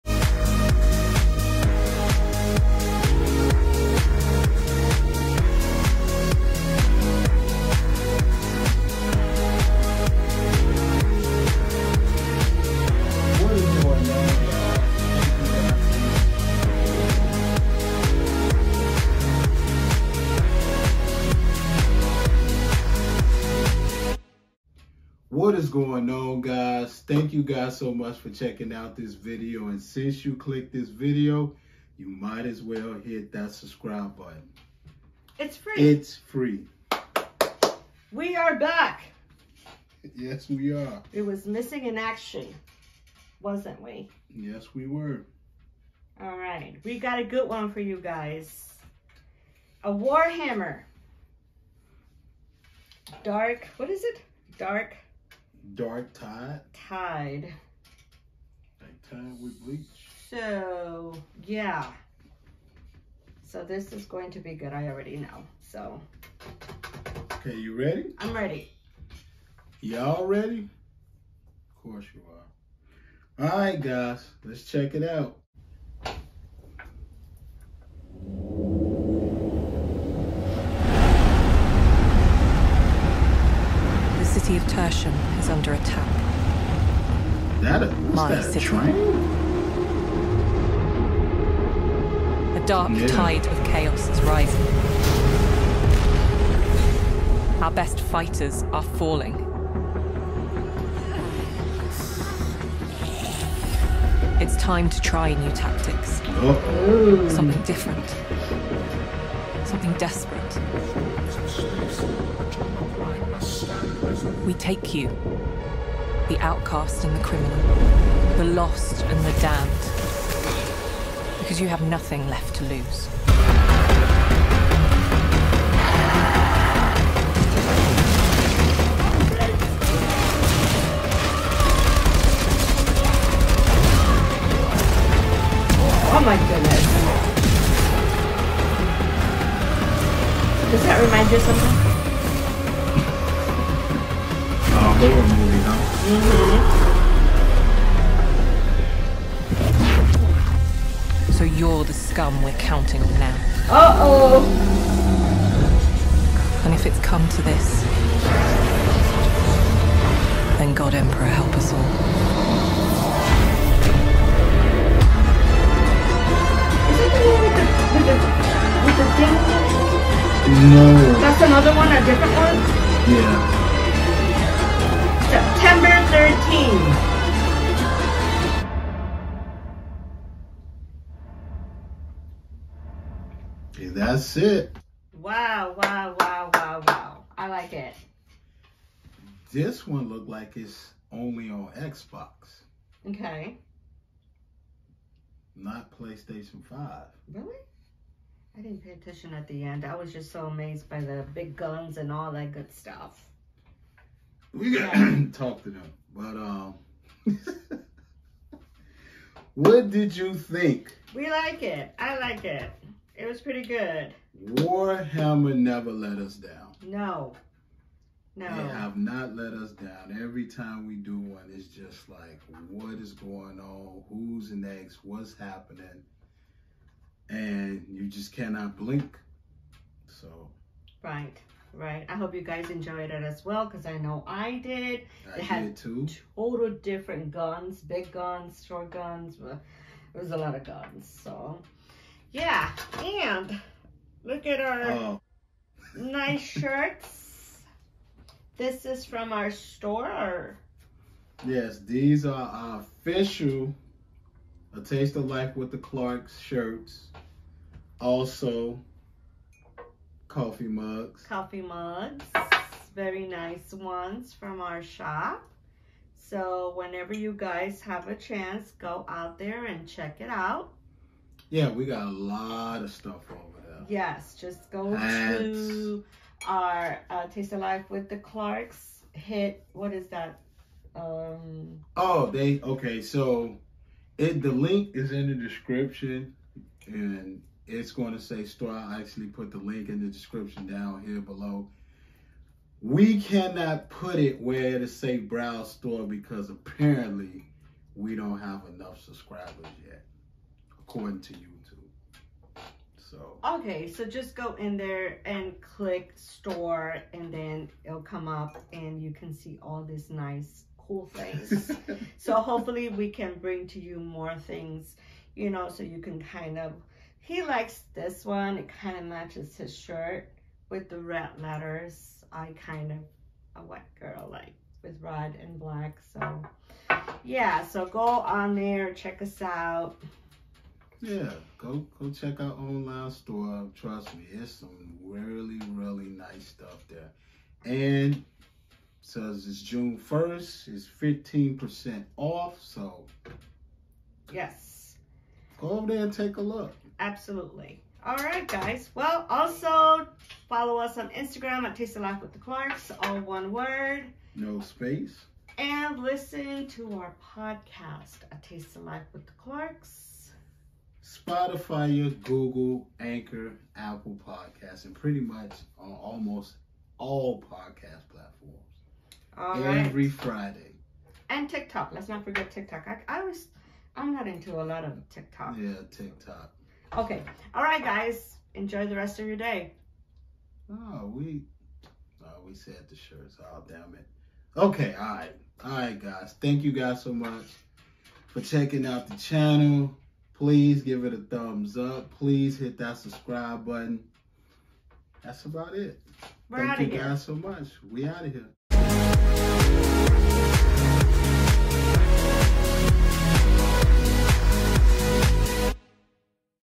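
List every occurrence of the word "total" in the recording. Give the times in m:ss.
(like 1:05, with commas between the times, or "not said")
3:56.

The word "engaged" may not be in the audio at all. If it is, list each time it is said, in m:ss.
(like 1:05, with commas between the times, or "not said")
not said.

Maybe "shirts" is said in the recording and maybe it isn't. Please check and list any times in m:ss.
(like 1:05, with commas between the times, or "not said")
4:06, 4:16, 5:19, 6:22.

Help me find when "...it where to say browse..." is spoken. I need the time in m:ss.
4:54.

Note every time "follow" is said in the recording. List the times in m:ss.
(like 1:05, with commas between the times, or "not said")
5:50.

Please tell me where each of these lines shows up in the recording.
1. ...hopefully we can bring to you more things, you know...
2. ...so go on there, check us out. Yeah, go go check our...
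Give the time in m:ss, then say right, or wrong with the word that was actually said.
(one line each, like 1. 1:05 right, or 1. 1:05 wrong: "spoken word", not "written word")
1. 5:12 right
2. 5:27 right.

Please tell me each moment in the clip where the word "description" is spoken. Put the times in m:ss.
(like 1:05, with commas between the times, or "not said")
4:45, 4:50.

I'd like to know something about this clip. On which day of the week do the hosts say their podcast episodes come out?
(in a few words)
Friday.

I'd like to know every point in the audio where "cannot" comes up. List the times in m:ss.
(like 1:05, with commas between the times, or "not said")
3:48, 4:53.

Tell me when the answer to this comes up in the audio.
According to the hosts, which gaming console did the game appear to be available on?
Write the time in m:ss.
3:11.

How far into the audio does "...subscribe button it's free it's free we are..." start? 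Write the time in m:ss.
0:33.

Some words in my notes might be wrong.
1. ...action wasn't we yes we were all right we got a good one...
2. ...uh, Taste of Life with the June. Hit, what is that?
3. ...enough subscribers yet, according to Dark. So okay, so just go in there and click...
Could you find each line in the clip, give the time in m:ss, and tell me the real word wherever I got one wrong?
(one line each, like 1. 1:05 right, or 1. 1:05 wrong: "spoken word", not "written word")
1. 0:41 right
2. 4:37 wrong: "Clarks", not "June"
3. 4:58 wrong: "YouTube", not "Dark".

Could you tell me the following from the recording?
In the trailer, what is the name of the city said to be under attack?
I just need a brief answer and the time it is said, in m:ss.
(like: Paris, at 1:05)
Tertium, at 1:24.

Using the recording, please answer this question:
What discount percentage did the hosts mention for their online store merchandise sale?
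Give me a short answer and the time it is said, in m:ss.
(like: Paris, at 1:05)
15%, at 5:40.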